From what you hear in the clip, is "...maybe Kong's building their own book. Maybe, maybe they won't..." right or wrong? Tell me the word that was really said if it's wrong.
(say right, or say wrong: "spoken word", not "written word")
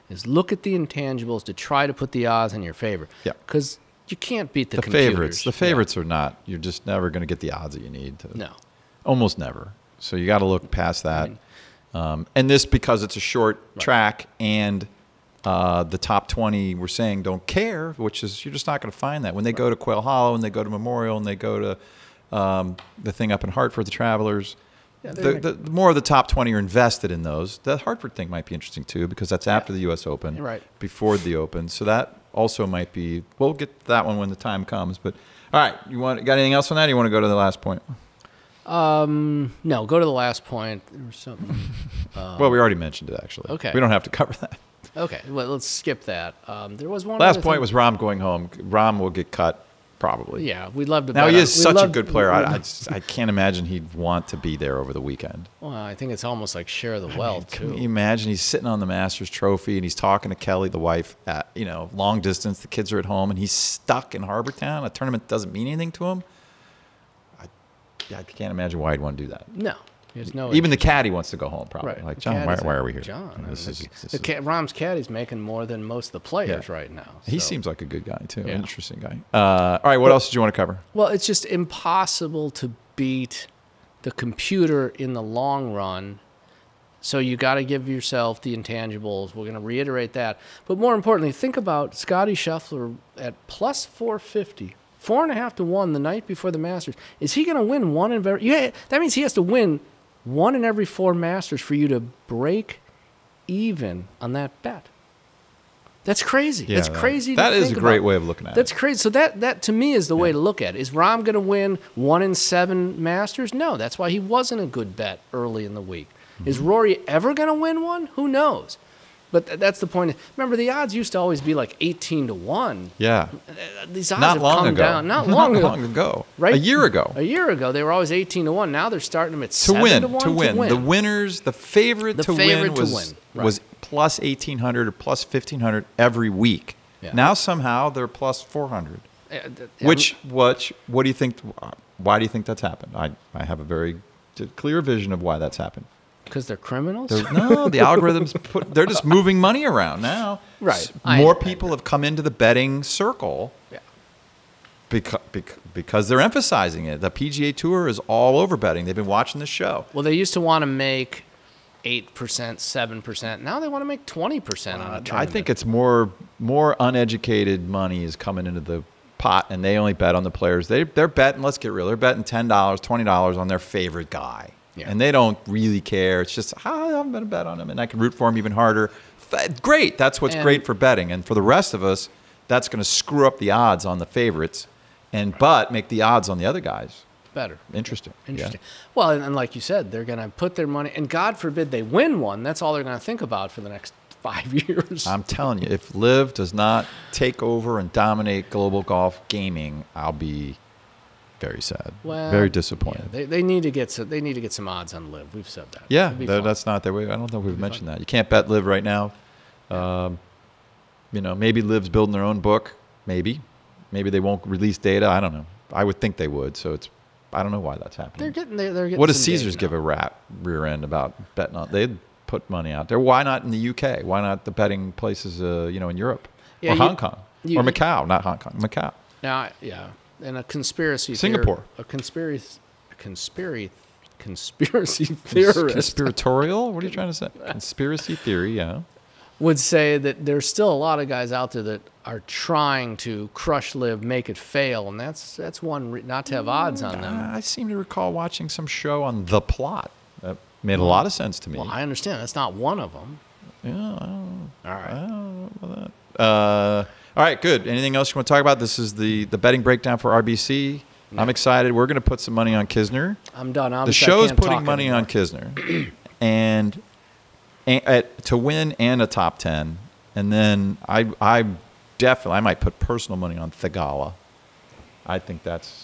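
wrong: "LIV", not "Kong".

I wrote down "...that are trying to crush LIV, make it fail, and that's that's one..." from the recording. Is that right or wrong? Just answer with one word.
right.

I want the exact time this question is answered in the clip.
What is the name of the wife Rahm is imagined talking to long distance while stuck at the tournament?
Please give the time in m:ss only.
1:00.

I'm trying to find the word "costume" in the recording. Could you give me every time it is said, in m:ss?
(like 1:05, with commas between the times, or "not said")
not said.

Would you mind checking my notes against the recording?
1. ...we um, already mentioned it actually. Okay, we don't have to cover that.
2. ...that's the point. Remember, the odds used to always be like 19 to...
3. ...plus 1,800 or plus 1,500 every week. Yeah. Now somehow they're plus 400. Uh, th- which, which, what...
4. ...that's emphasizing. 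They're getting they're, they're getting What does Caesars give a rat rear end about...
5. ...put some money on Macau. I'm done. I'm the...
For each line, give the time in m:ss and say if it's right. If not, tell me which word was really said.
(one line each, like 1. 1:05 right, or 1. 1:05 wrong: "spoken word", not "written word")
1. 0:42 right
2. 1:59 wrong: "18", not "19"
3. 2:13 right
4. 3:37 wrong: "happening", not "emphasizing"
5. 4:22 wrong: "Kisner", not "Macau".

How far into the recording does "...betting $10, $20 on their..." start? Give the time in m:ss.
2:51.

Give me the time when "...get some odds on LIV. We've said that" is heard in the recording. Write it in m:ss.
3:24.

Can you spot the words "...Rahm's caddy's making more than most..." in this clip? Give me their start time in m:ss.
1:14.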